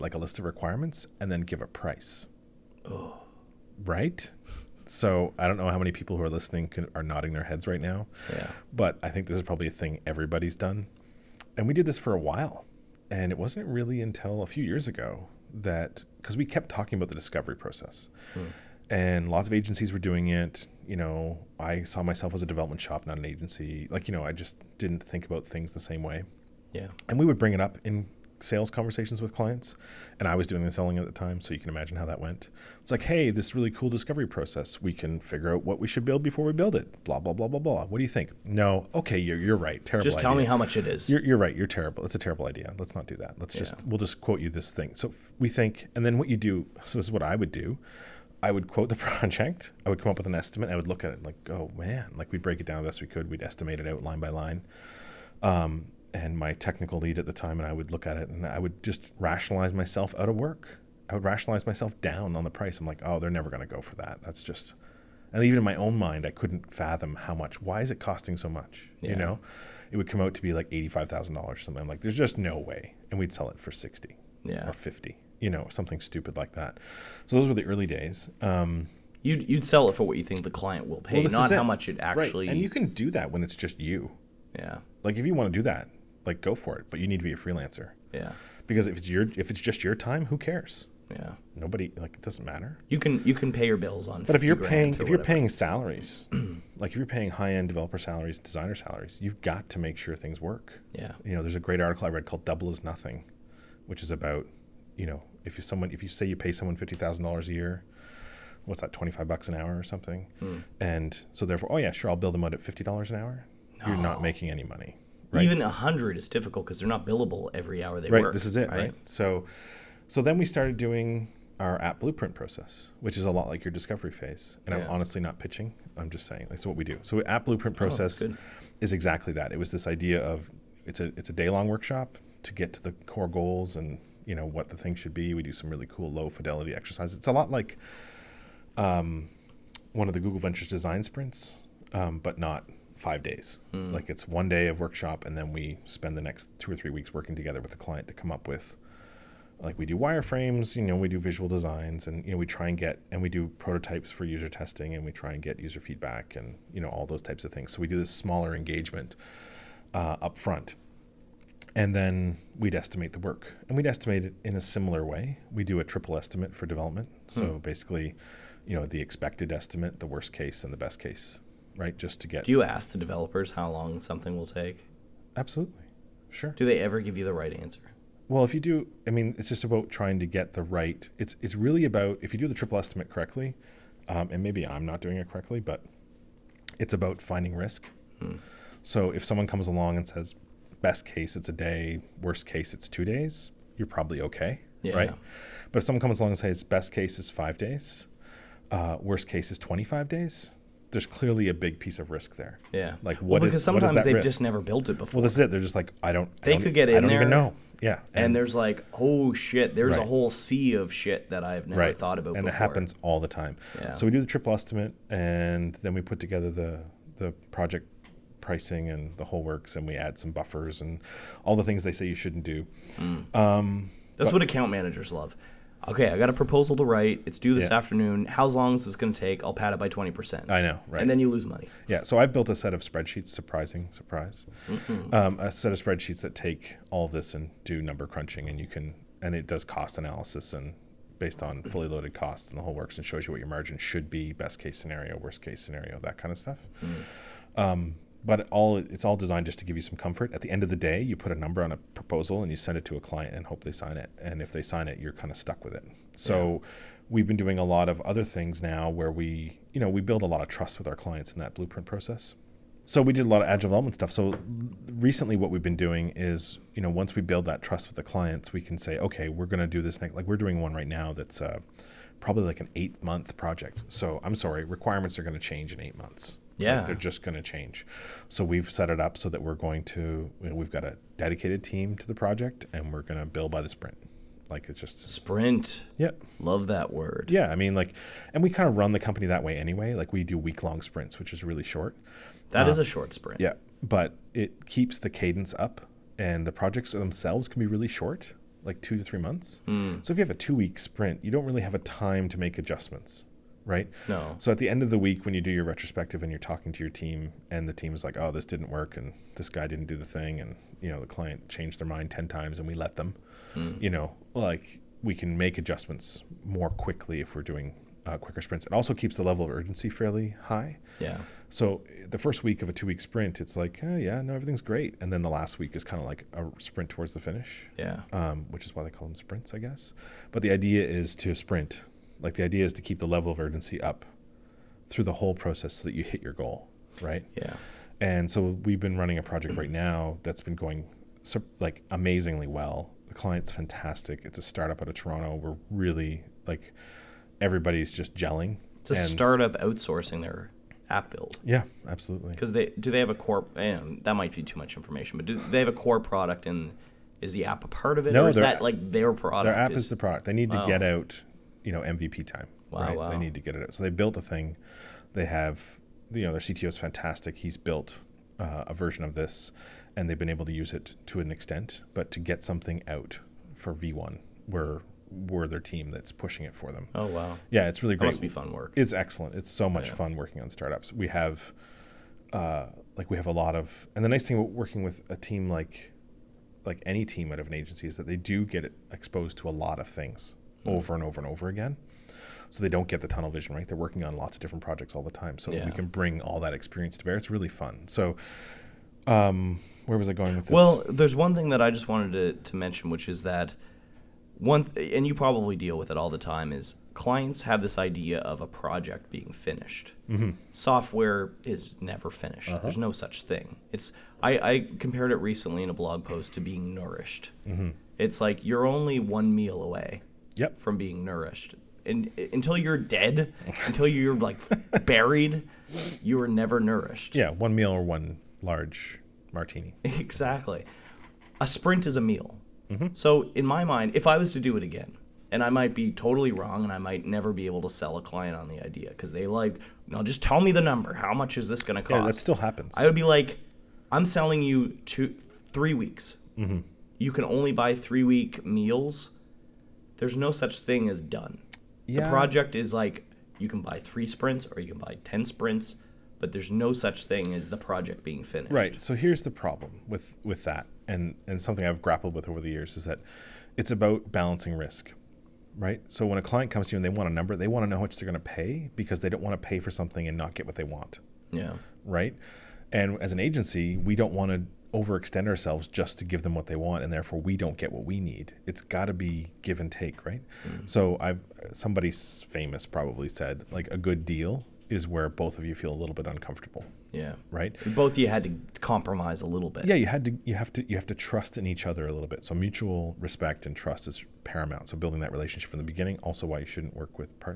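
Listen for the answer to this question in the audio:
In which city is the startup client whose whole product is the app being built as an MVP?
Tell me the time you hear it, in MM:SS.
05:44.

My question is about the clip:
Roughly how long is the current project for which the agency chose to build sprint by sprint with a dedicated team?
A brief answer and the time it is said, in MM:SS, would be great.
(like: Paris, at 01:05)
8 months, at 04:32.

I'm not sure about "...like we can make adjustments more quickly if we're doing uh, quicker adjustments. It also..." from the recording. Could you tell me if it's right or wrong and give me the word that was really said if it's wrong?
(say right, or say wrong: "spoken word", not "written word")
wrong: "sprints", not "adjustments".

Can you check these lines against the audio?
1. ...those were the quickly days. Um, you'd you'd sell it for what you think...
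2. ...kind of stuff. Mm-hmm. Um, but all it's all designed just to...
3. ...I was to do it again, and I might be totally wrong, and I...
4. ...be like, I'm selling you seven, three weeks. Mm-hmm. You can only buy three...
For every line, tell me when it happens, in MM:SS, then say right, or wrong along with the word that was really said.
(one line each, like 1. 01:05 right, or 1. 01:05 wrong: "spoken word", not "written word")
1. 01:17 wrong: "early", not "quickly"
2. 04:06 right
3. 07:14 right
4. 07:22 wrong: "two", not "seven".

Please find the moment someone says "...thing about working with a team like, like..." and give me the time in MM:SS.
06:24.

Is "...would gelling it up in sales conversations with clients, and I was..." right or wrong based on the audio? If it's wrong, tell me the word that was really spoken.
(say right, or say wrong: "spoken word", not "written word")
wrong: "bring", not "gelling".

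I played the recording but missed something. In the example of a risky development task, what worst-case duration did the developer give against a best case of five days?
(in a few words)
25 days.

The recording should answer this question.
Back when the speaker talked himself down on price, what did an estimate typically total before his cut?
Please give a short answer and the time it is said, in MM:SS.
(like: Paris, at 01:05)
$85,000, at 01:10.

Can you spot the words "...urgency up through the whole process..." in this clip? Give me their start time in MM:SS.
05:33.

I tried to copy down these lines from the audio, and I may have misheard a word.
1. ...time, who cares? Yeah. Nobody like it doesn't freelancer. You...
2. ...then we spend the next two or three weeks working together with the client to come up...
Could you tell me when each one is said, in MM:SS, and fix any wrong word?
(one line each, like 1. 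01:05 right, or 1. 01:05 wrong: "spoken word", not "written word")
1. 01:29 wrong: "matter", not "freelancer"
2. 02:25 right.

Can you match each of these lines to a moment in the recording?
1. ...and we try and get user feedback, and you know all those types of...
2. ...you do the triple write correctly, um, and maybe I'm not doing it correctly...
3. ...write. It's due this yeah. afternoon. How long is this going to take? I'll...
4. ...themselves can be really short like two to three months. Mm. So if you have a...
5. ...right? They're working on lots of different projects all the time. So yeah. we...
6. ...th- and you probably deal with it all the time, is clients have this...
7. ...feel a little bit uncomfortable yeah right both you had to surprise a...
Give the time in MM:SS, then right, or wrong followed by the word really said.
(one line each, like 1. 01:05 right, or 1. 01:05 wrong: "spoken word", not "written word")
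1. 02:34 right
2. 03:02 wrong: "estimate", not "write"
3. 03:46 right
4. 04:56 right
5. 06:33 right
6. 06:44 right
7. 08:05 wrong: "compromise", not "surprise".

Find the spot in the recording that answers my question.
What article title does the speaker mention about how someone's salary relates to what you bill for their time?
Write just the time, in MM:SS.
01:42.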